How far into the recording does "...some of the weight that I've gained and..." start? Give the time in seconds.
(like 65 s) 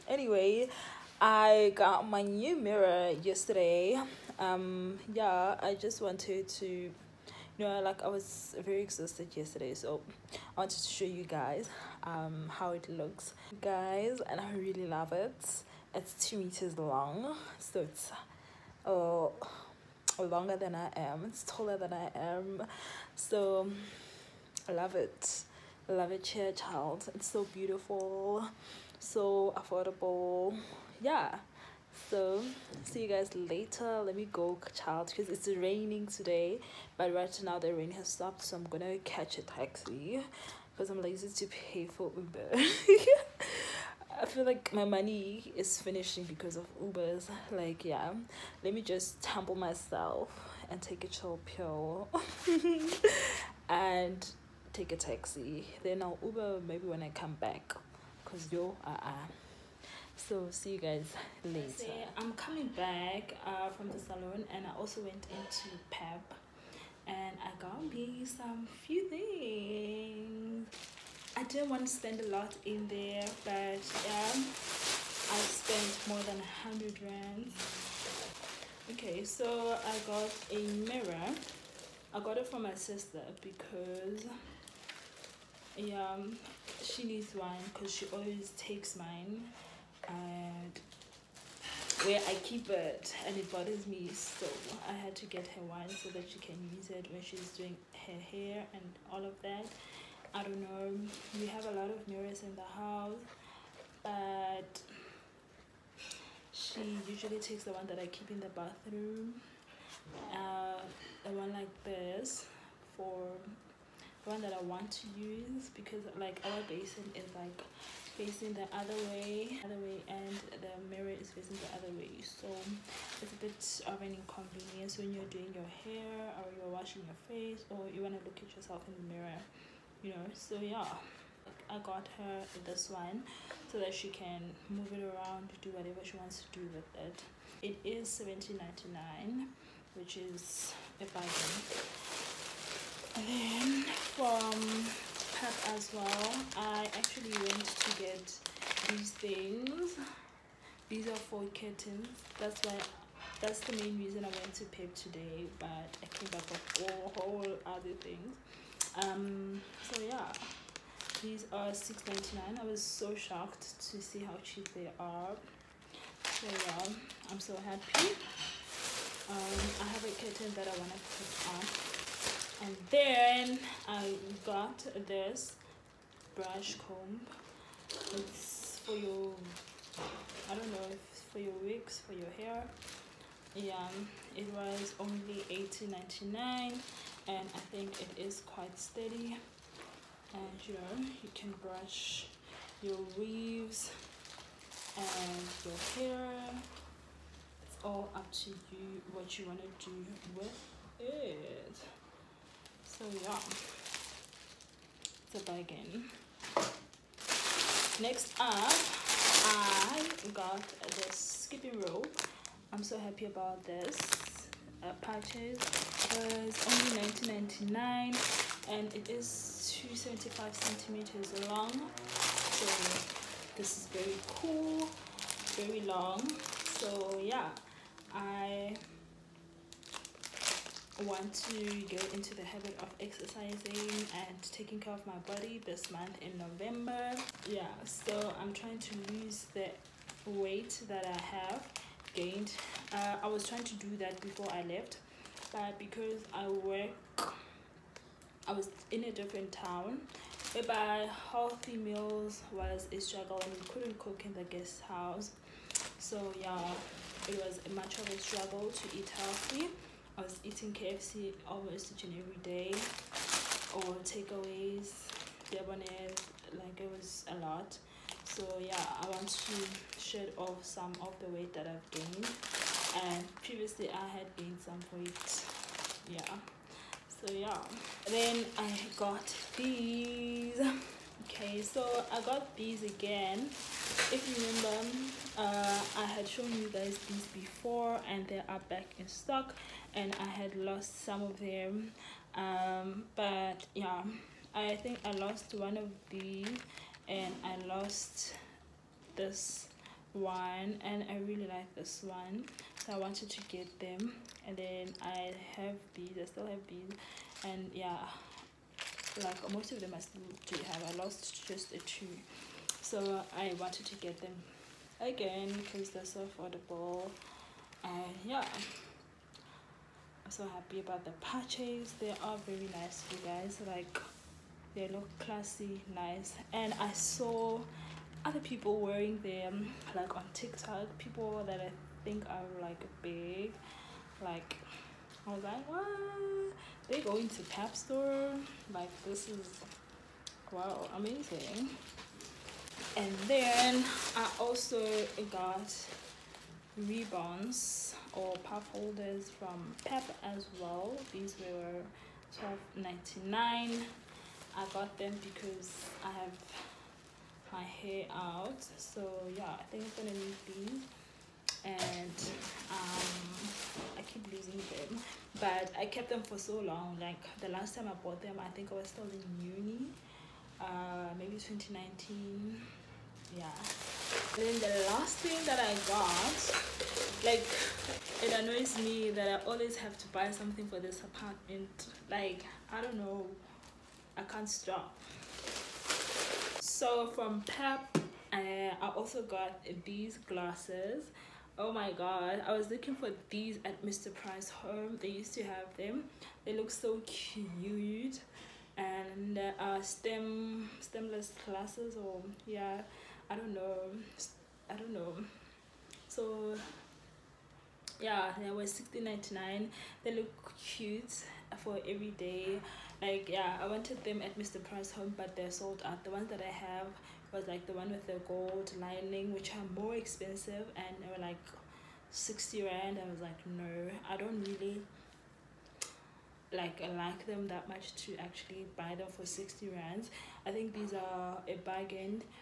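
270 s.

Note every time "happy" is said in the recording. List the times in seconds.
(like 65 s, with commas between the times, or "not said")
167 s, 212 s, 320 s.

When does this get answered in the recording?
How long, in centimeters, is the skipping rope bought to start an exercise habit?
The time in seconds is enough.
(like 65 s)
219 s.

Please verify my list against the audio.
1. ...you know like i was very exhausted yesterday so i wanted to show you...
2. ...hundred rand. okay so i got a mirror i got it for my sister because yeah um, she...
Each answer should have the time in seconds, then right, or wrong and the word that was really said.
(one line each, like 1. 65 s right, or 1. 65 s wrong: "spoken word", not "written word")
1. 6 s right
2. 76 s right.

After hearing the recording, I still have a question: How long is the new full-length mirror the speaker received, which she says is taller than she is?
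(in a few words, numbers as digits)
2 meters.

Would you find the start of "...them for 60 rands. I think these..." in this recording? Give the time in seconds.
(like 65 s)
428 s.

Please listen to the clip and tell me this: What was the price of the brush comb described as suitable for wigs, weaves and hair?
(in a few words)
18.99.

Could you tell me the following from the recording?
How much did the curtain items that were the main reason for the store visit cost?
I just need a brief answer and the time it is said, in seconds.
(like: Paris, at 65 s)
6.99, at 161 s.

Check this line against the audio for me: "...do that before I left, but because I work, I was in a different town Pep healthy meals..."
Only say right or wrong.
wrong.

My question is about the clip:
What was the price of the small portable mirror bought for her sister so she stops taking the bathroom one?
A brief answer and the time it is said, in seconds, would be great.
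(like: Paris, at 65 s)
17.99, at 138 s.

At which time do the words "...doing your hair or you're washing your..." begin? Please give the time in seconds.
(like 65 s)
125 s.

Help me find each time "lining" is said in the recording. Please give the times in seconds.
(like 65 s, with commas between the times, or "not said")
418 s.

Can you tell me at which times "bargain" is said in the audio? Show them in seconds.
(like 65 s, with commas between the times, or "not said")
141 s, 205 s, 431 s.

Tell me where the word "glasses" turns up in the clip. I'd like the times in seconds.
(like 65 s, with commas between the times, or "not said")
390 s, 401 s.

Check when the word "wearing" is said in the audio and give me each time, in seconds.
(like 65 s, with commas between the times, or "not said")
328 s.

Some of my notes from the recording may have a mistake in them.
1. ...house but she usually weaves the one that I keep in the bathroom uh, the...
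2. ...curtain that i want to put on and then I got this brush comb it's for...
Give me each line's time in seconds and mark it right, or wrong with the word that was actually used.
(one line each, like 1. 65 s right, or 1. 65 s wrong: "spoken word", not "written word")
1. 102 s wrong: "takes", not "weaves"
2. 170 s right.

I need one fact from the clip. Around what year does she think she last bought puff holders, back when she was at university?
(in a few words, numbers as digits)
2019.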